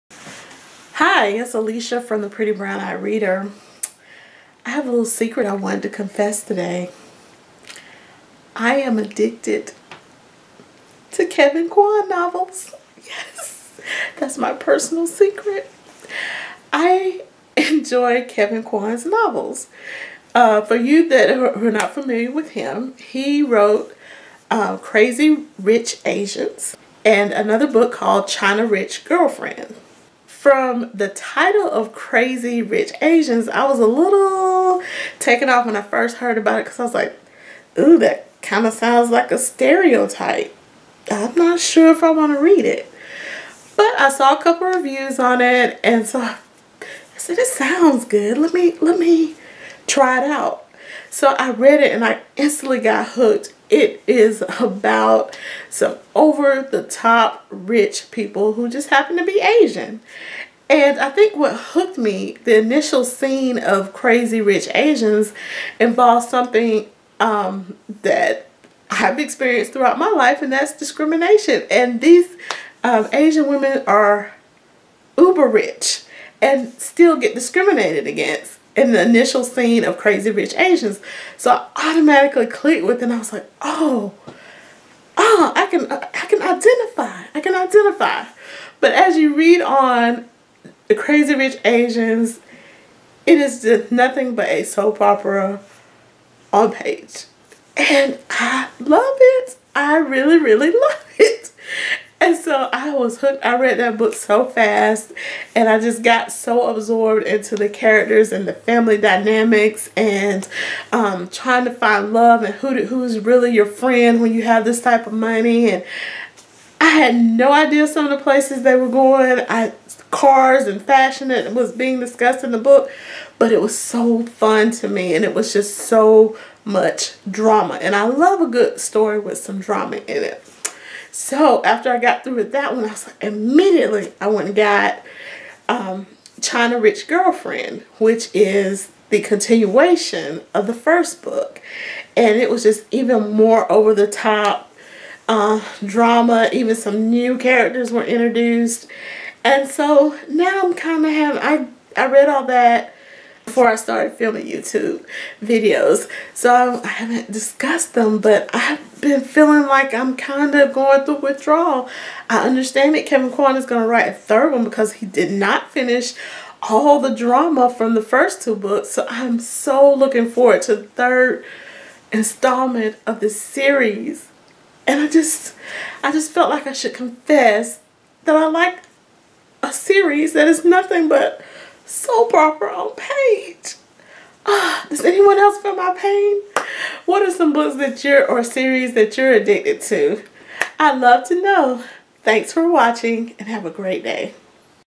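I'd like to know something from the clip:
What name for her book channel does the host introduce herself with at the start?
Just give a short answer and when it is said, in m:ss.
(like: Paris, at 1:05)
Pretty Brown Eye Reader, at 0:02.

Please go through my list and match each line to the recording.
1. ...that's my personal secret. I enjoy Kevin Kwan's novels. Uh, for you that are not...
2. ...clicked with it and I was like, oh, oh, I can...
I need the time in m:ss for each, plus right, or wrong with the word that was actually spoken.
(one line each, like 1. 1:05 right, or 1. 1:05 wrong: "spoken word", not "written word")
1. 0:14 right
2. 1:22 right.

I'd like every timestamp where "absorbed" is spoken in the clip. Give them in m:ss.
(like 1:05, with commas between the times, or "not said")
1:46.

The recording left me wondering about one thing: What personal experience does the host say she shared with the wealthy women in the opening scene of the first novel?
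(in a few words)
discrimination.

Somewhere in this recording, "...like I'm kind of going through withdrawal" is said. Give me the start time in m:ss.
2:39.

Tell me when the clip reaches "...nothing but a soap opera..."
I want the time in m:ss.
1:33.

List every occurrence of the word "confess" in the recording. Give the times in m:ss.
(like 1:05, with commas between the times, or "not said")
0:05, 2:56.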